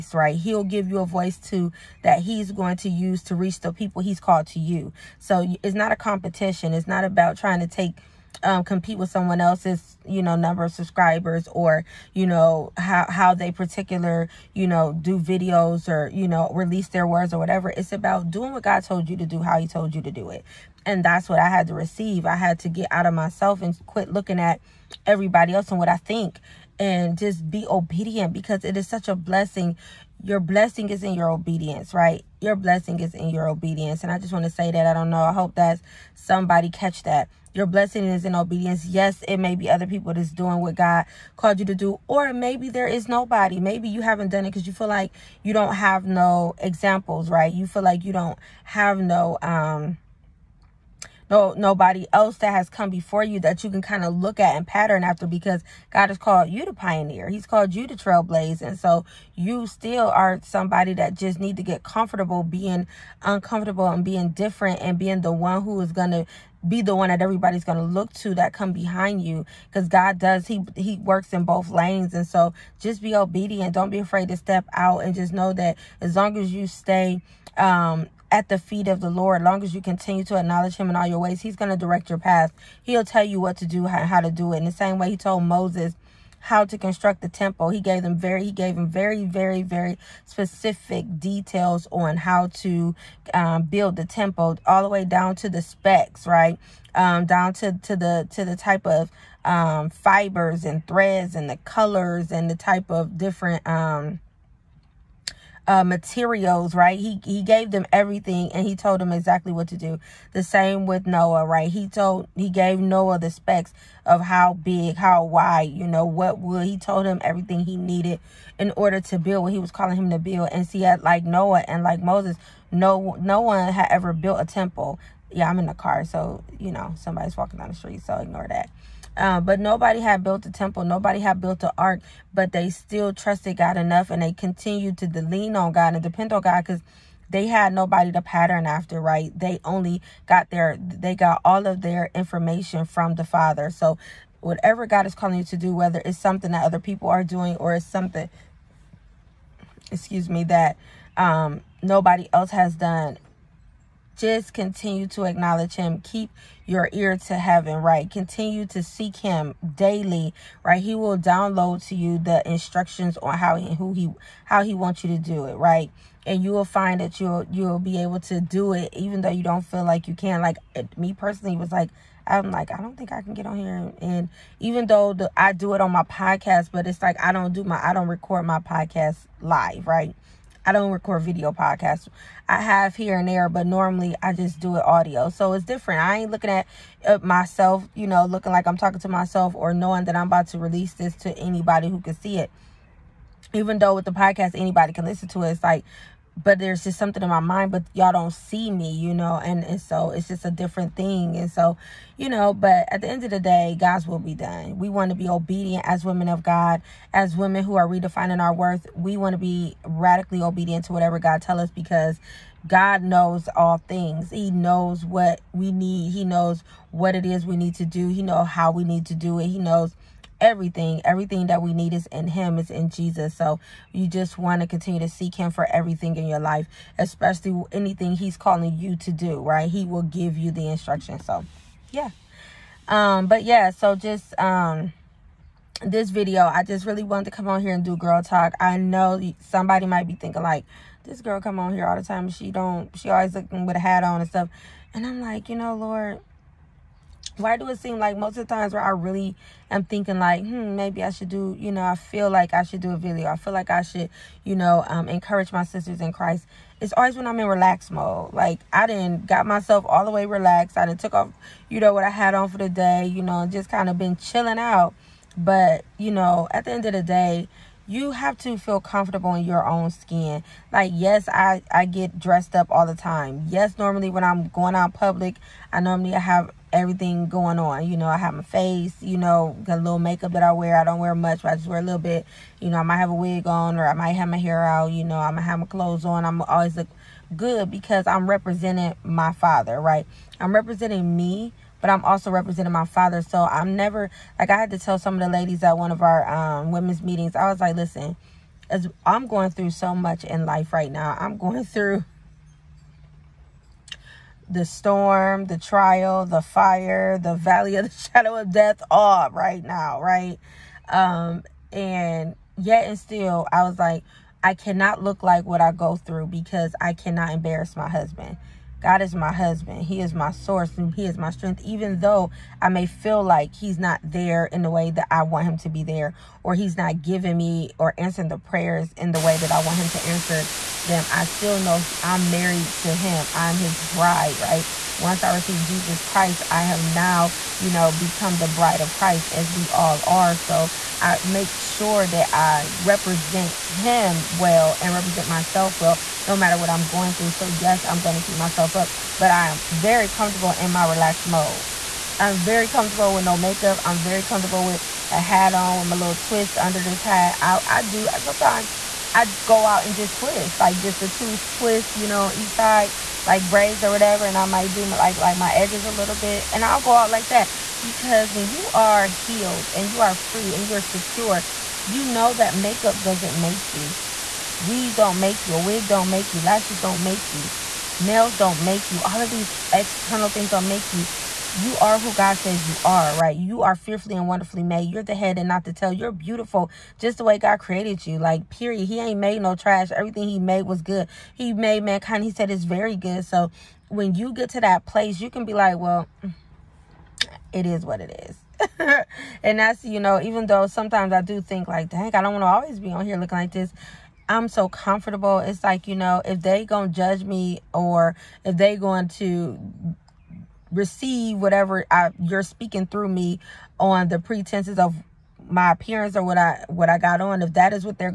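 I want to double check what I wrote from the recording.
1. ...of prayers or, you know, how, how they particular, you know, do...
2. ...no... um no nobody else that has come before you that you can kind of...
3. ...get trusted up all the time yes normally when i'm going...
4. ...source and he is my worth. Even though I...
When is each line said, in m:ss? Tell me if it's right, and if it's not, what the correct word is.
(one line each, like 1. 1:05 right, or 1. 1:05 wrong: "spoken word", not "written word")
1. 0:10 wrong: "subscribers", not "prayers"
2. 0:48 right
3. 4:31 wrong: "dressed", not "trusted"
4. 5:20 wrong: "strength", not "worth".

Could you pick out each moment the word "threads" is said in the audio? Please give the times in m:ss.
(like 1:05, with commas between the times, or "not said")
1:40.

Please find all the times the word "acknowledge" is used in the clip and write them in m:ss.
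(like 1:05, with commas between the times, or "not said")
1:20, 2:35.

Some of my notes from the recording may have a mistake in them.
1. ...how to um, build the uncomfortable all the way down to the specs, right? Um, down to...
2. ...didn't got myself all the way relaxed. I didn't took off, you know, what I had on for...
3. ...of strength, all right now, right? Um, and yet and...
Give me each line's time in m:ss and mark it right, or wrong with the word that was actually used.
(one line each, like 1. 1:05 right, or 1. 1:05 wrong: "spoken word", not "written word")
1. 1:32 wrong: "temple", not "uncomfortable"
2. 4:18 right
3. 5:08 wrong: "death", not "strength".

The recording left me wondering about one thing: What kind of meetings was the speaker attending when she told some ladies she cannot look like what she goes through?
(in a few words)
Women's meetings.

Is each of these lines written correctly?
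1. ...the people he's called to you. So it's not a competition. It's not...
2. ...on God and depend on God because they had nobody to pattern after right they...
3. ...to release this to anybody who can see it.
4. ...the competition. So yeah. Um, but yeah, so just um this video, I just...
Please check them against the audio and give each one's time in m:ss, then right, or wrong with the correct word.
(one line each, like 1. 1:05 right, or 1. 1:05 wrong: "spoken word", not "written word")
1. 0:03 right
2. 2:15 right
3. 3:10 right
4. 3:50 wrong: "instruction", not "competition".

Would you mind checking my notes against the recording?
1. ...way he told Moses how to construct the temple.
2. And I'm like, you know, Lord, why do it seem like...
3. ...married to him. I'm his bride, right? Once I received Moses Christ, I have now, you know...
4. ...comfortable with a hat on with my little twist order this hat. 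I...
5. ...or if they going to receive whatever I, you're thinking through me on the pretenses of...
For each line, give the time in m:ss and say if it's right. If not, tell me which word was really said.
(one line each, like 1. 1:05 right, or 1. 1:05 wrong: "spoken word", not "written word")
1. 1:24 right
2. 4:04 right
3. 5:32 wrong: "Jesus", not "Moses"
4. 5:54 wrong: "under", not "order"
5. 6:47 wrong: "speaking", not "thinking".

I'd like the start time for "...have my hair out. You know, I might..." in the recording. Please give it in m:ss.
4:44.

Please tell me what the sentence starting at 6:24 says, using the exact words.
You're the head and not the tail.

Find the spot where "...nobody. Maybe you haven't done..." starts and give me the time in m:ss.
0:43.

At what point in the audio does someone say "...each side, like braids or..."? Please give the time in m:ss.
6:02.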